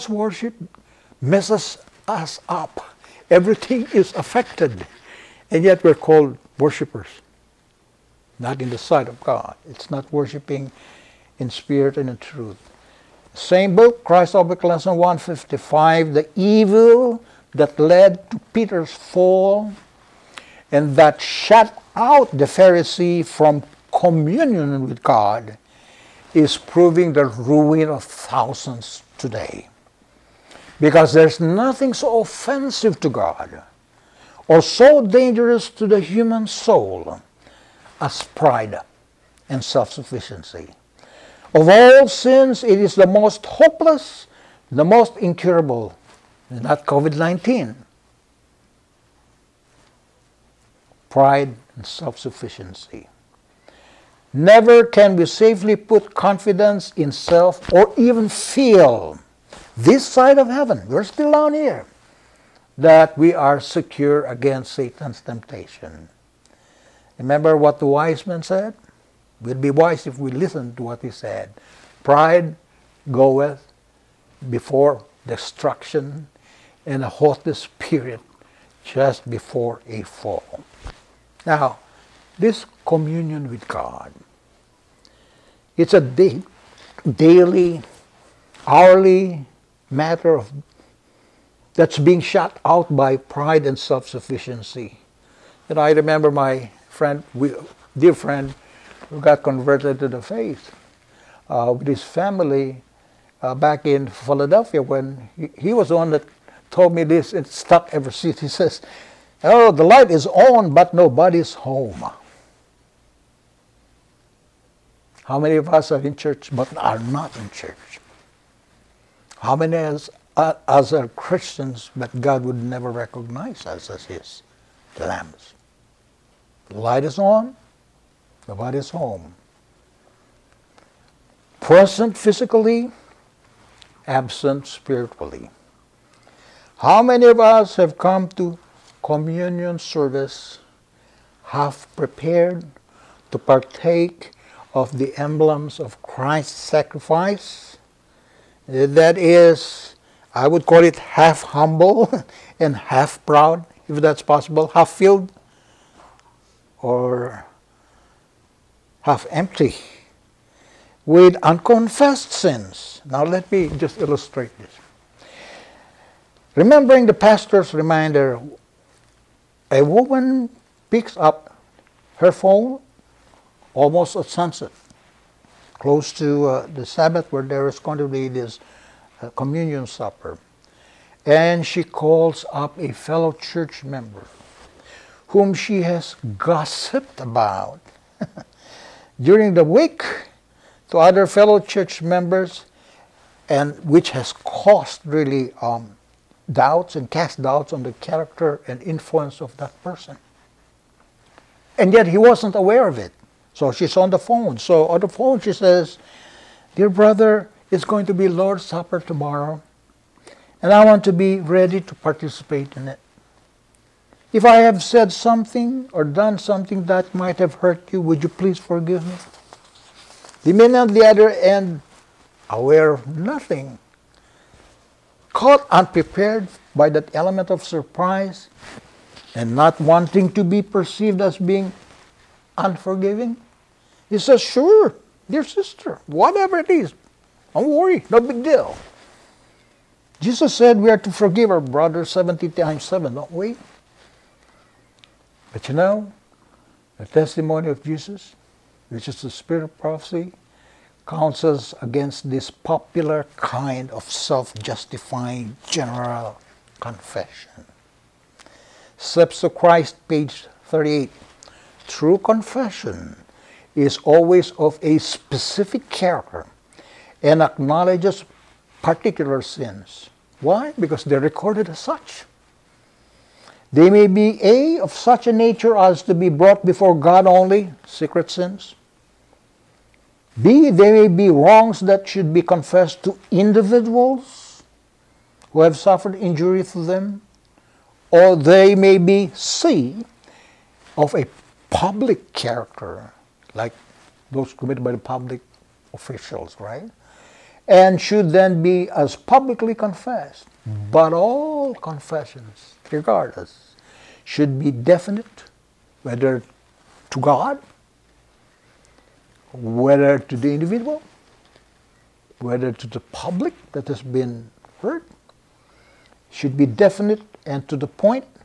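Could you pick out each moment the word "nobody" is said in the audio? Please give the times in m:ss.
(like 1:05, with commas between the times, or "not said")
1:50, 2:08.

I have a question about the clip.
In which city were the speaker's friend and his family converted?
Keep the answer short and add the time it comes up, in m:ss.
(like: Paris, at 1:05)
Philadelphia, at 1:44.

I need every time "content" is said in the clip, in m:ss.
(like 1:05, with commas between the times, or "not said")
not said.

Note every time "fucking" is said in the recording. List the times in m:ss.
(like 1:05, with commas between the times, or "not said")
not said.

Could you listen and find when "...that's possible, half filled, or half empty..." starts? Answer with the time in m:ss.
2:34.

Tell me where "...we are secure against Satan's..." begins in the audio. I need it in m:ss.
1:03.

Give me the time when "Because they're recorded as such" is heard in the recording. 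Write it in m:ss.
4:30.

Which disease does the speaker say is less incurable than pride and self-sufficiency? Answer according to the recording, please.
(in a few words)
COVID-19.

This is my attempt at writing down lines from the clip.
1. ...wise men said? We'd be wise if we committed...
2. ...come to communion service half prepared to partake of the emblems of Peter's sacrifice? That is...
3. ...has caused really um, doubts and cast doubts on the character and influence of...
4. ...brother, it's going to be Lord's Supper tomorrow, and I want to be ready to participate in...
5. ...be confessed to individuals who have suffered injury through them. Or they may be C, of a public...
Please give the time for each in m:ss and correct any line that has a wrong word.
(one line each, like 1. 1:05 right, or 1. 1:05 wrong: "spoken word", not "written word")
1. 1:07 wrong: "listened", not "committed"
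2. 2:17 wrong: "Christ", not "Peter"
3. 3:14 right
4. 3:26 right
5. 4:42 right.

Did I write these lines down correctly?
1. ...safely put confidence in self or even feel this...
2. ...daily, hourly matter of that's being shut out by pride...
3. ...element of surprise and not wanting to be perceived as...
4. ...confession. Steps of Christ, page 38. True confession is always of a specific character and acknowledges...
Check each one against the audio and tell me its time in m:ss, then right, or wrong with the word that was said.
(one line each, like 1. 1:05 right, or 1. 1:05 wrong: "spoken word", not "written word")
1. 0:55 right
2. 1:27 right
3. 3:47 right
4. 4:16 right.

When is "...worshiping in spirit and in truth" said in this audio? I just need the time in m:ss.
0:10.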